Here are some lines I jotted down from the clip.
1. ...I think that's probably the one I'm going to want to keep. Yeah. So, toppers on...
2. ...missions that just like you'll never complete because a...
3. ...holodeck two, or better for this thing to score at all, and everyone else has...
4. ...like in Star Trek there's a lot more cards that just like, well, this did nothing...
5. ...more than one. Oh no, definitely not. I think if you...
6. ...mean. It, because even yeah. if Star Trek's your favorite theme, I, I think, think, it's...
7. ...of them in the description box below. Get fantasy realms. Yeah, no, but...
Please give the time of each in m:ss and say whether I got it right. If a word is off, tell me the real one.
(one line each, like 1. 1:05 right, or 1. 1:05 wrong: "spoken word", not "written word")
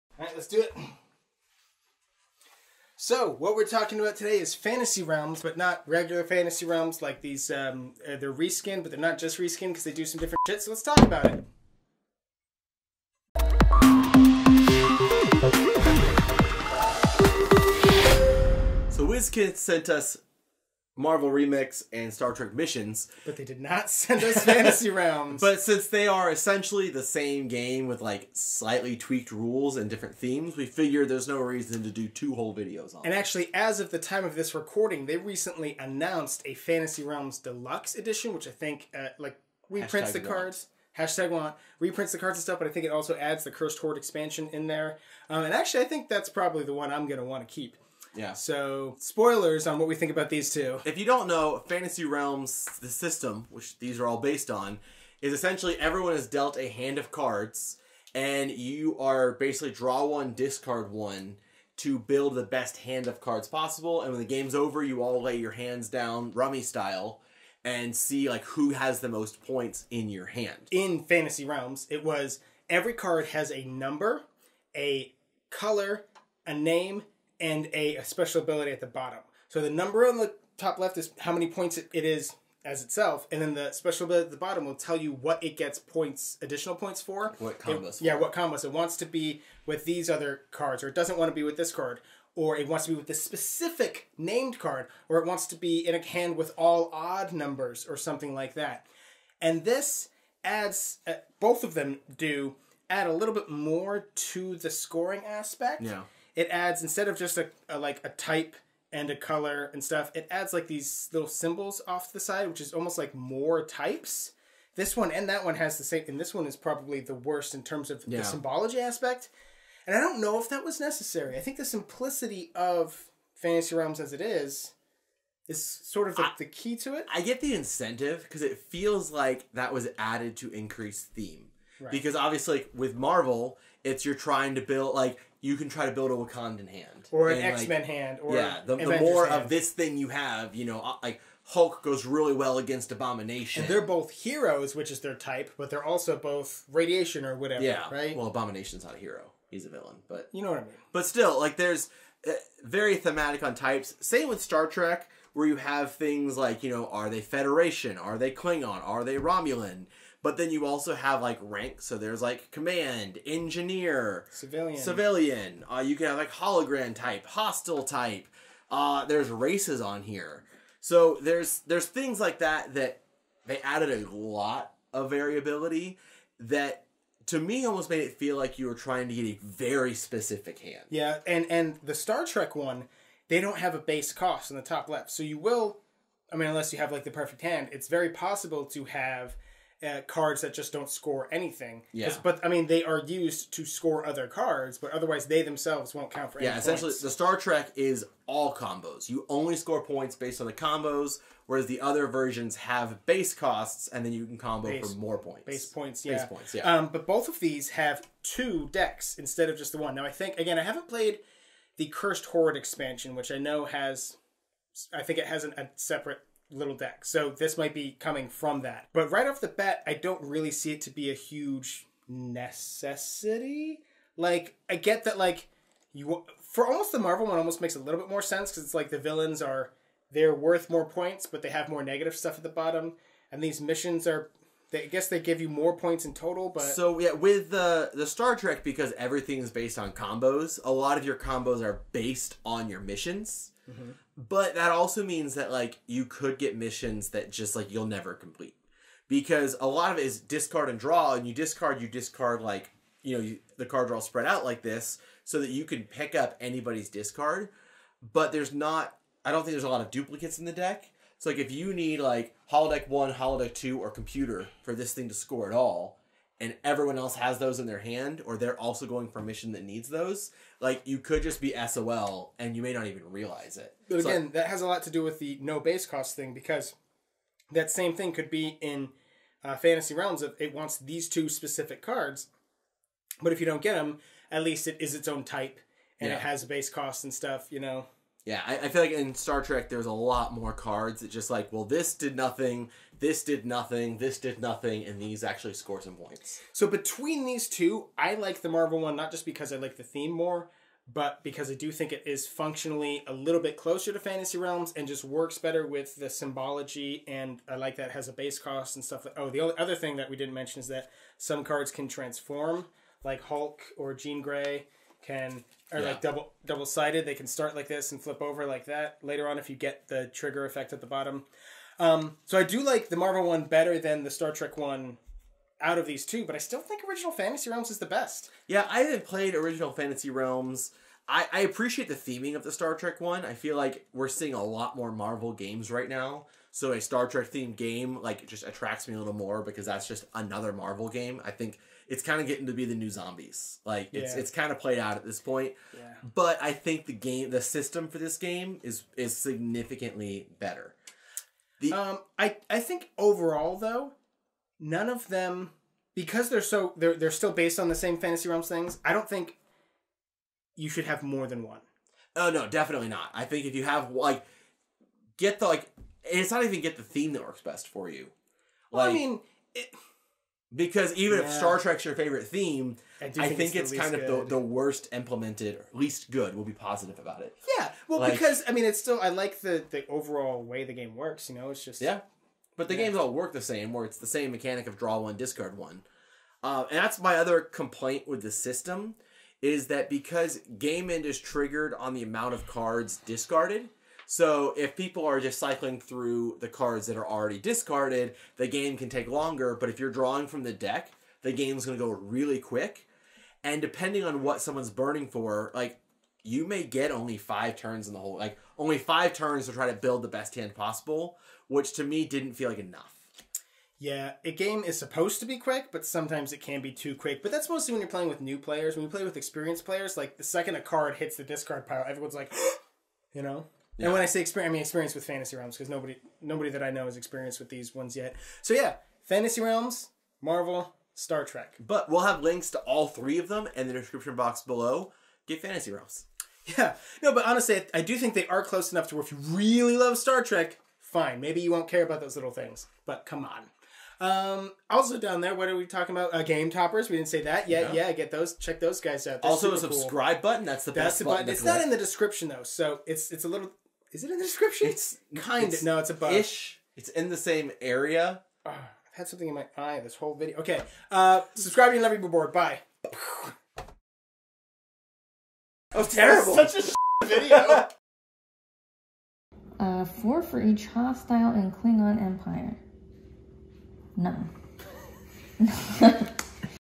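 1. 0:45 wrong: "spoilers", not "toppers"
2. 4:06 right
3. 4:23 wrong: "computer", not "better"
4. 4:48 right
5. 6:01 right
6. 6:08 right
7. 7:13 right.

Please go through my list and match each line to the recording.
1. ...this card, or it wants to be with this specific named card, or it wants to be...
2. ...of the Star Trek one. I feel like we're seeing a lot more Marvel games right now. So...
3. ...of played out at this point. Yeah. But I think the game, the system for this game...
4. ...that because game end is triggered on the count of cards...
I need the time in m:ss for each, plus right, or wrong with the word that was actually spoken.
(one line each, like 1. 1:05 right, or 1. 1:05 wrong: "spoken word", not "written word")
1. 1:31 right
2. 5:32 right
3. 5:44 right
4. 6:29 wrong: "amount", not "count".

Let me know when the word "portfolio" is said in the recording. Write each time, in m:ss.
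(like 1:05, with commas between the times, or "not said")
not said.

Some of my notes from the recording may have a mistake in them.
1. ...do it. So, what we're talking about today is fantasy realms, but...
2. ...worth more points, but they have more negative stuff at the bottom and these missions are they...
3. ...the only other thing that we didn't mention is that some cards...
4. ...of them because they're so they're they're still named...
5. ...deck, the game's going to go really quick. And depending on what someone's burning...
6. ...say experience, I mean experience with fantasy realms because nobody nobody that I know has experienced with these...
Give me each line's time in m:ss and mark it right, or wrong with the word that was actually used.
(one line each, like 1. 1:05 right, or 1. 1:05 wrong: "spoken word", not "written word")
1. 0:00 right
2. 3:50 right
3. 5:09 right
4. 5:54 wrong: "based", not "named"
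5. 6:40 right
6. 7:04 right.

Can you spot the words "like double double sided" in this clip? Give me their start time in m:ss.
5:15.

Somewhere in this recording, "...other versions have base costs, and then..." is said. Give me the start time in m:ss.
3:21.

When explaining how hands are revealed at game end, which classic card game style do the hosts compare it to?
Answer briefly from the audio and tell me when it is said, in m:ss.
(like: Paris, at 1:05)
Rummy, at 1:06.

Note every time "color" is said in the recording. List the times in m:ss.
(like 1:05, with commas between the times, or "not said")
1:15, 1:49.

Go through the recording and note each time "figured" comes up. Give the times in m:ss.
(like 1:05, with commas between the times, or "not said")
0:30.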